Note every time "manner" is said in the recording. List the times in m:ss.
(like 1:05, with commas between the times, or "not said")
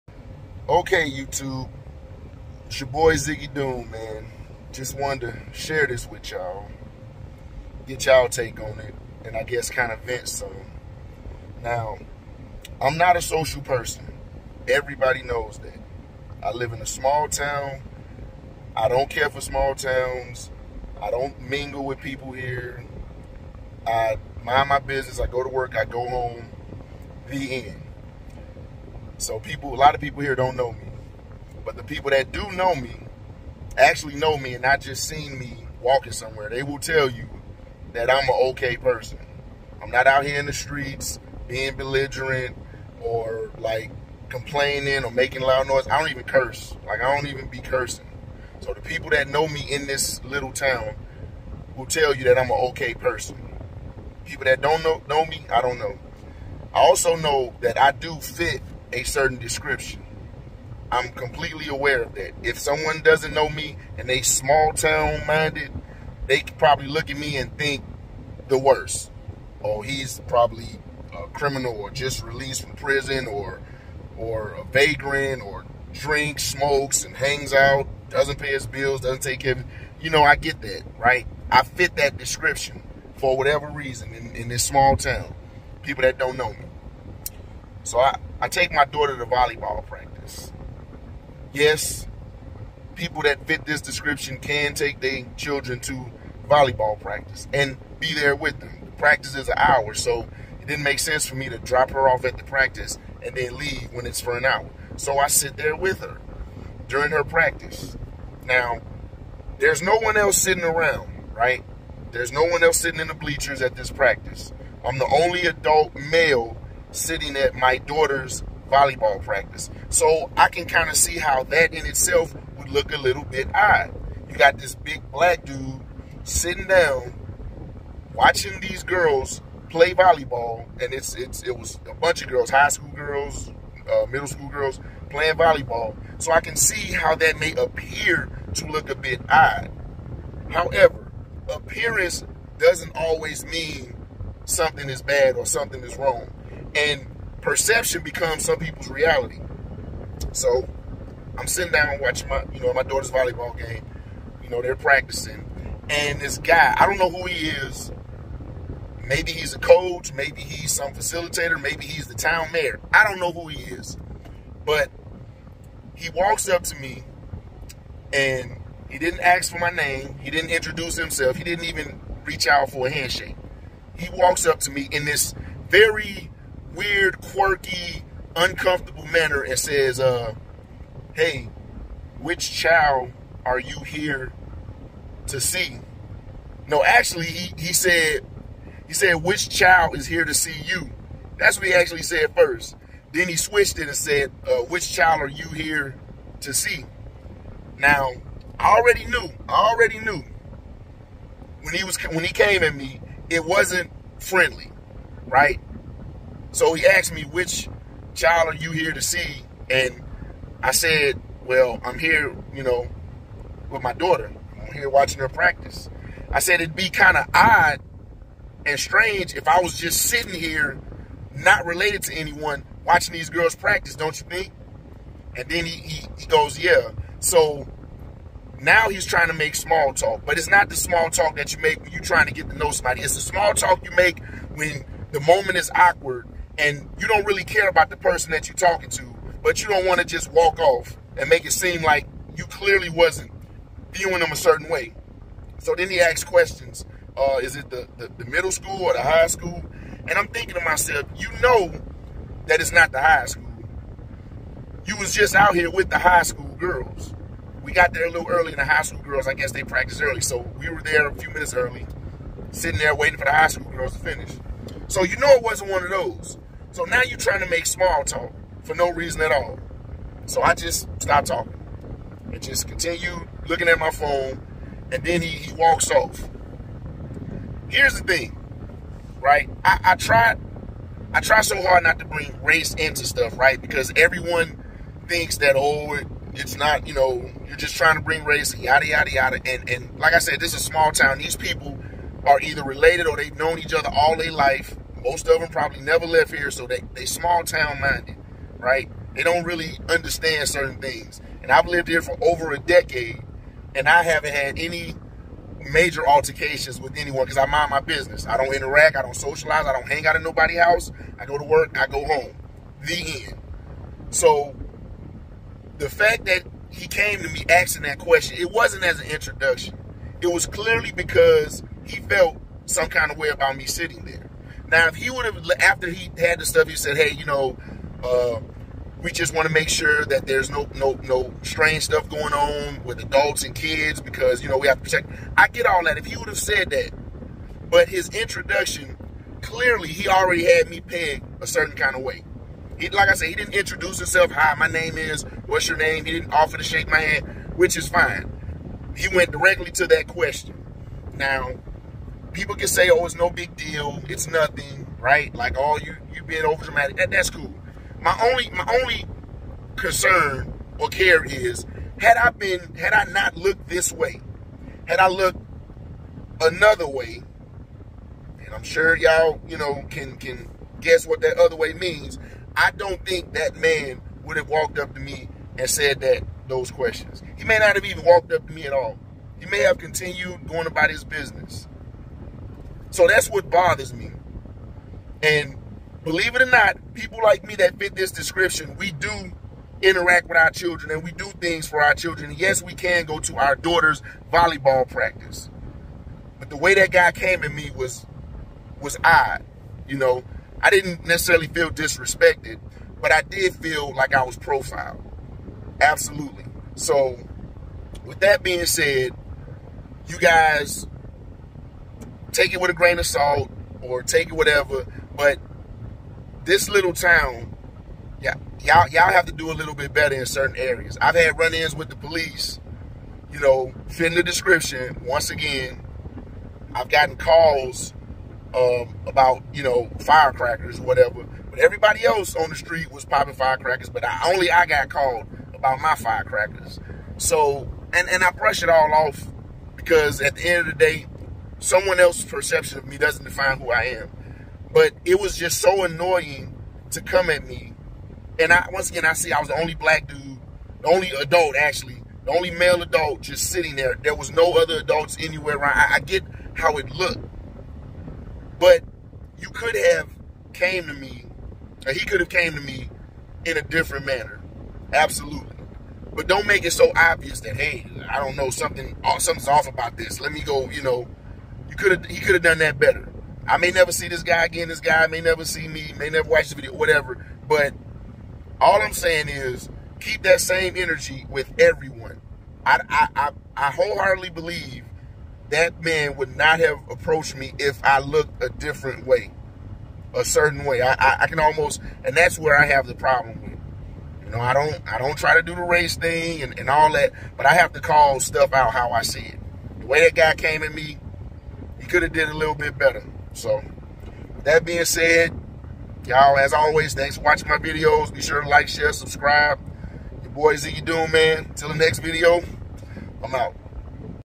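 2:59, 7:44.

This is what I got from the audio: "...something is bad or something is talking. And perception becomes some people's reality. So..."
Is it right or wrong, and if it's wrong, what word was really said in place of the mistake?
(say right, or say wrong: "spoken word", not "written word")
wrong: "wrong", not "talking".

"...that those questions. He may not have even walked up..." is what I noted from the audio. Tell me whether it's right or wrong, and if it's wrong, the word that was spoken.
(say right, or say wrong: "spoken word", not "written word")
right.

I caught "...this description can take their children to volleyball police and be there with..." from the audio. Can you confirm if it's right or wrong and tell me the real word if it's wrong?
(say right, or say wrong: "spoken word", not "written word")
wrong: "practice", not "police".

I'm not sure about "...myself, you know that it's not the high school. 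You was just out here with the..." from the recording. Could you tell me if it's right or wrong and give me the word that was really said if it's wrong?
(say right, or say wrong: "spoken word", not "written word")
right.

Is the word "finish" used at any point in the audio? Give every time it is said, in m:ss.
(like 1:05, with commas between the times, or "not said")
4:23.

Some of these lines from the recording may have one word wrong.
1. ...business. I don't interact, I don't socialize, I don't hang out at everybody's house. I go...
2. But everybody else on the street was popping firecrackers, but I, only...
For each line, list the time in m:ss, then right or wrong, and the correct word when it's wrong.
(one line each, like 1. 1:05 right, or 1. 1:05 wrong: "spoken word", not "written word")
1. 5:07 wrong: "nobody", not "everybody"
2. 7:11 right.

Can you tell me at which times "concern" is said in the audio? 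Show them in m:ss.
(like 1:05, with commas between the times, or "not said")
5:59.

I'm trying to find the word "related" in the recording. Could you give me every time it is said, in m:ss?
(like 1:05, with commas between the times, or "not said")
3:41, 4:52.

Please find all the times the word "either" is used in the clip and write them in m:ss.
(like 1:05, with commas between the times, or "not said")
4:52.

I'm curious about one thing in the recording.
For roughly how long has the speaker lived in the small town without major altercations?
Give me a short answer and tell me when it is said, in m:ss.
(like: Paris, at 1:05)
Over a decade, at 5:02.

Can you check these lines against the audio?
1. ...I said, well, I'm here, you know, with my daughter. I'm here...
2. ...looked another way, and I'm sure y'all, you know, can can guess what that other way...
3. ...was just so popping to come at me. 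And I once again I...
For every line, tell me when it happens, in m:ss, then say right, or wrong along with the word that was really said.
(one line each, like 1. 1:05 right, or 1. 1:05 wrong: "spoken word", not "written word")
1. 3:30 right
2. 6:05 right
3. 7:25 wrong: "annoying", not "popping".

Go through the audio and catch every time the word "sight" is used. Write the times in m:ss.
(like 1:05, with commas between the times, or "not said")
not said.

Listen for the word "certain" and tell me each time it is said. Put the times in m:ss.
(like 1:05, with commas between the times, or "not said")
0:59, 4:04, 5:00, 5:41, 7:00, 8:10.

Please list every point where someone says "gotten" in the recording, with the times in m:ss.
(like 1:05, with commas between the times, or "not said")
7:06.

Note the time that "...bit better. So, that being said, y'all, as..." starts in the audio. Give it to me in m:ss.
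8:22.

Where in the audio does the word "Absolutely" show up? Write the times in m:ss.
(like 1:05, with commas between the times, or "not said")
6:45, 7:44.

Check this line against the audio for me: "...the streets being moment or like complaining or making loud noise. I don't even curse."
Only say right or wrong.
wrong.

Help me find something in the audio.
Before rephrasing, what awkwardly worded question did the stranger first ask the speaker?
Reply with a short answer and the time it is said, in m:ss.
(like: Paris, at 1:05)
Which child is here to see you?, at 3:09.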